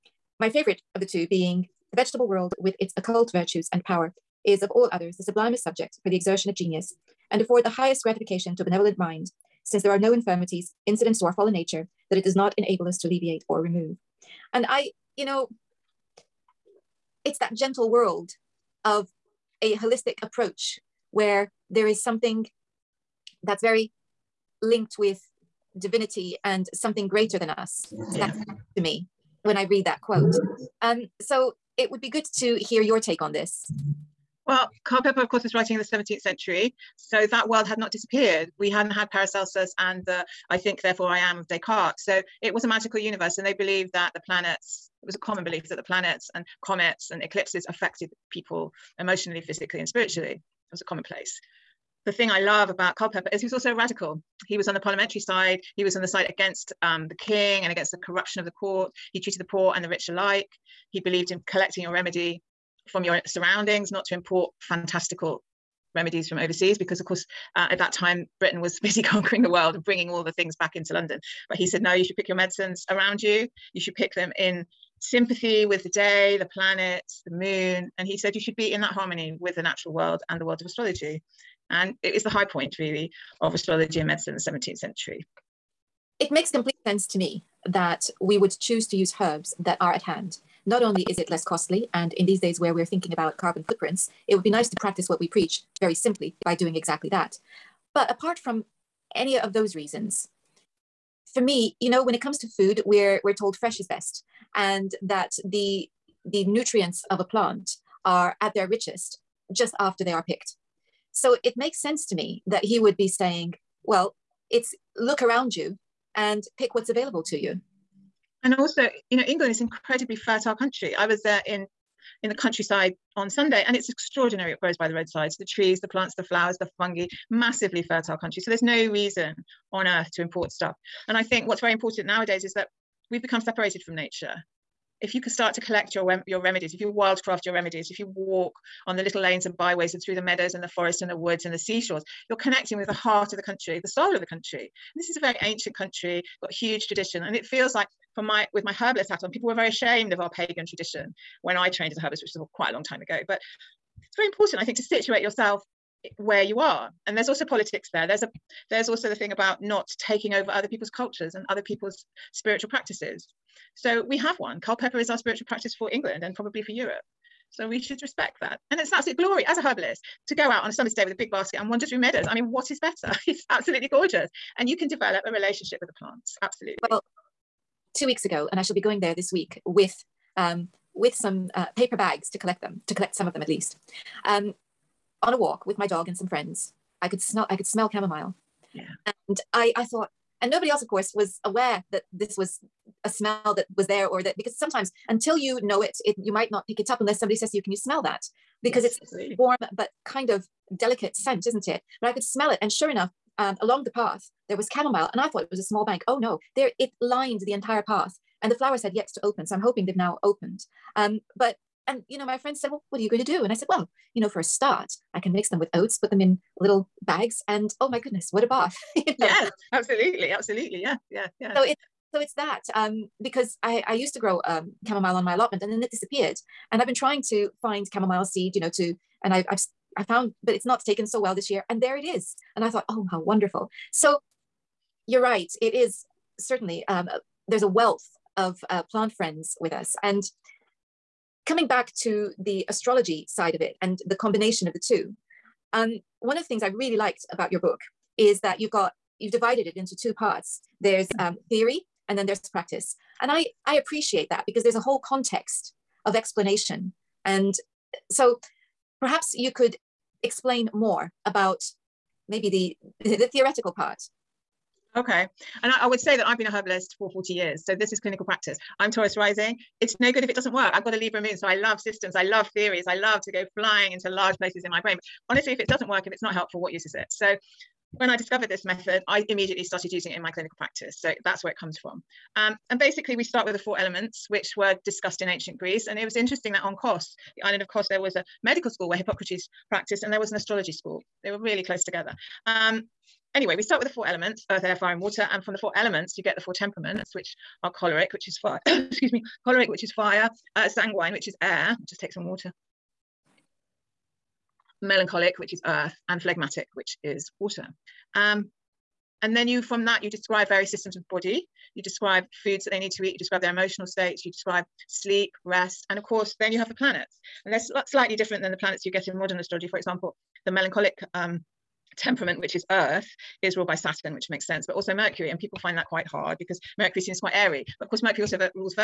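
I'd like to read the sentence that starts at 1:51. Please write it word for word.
So it makes sense to me that he would be saying, well, it's look around you and pick what's available to you.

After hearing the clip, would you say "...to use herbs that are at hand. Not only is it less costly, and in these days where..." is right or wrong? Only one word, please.
right.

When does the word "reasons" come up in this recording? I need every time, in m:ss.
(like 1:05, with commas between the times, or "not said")
1:39, 2:08.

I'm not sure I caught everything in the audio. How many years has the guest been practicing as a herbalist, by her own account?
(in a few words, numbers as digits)
40.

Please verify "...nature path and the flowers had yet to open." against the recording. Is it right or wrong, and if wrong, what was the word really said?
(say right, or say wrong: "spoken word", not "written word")
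wrong: "entire", not "nature".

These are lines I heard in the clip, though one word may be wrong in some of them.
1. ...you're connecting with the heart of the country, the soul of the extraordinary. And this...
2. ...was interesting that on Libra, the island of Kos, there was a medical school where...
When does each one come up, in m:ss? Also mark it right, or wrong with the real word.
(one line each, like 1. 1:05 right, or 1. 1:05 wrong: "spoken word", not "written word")
1. 2:22 wrong: "country", not "extraordinary"
2. 4:46 wrong: "Kos", not "Libra".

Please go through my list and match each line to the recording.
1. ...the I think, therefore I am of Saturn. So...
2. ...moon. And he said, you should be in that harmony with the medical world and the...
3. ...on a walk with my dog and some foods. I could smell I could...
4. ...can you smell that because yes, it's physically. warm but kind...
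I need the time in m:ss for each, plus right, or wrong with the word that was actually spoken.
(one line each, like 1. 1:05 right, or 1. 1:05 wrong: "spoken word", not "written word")
1. 0:40 wrong: "Descartes", not "Saturn"
2. 1:17 wrong: "natural", not "medical"
3. 3:05 wrong: "friends", not "foods"
4. 3:17 wrong: "absolutely", not "physically".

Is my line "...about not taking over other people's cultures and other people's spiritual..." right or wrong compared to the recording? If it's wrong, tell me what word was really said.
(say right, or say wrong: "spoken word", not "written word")
right.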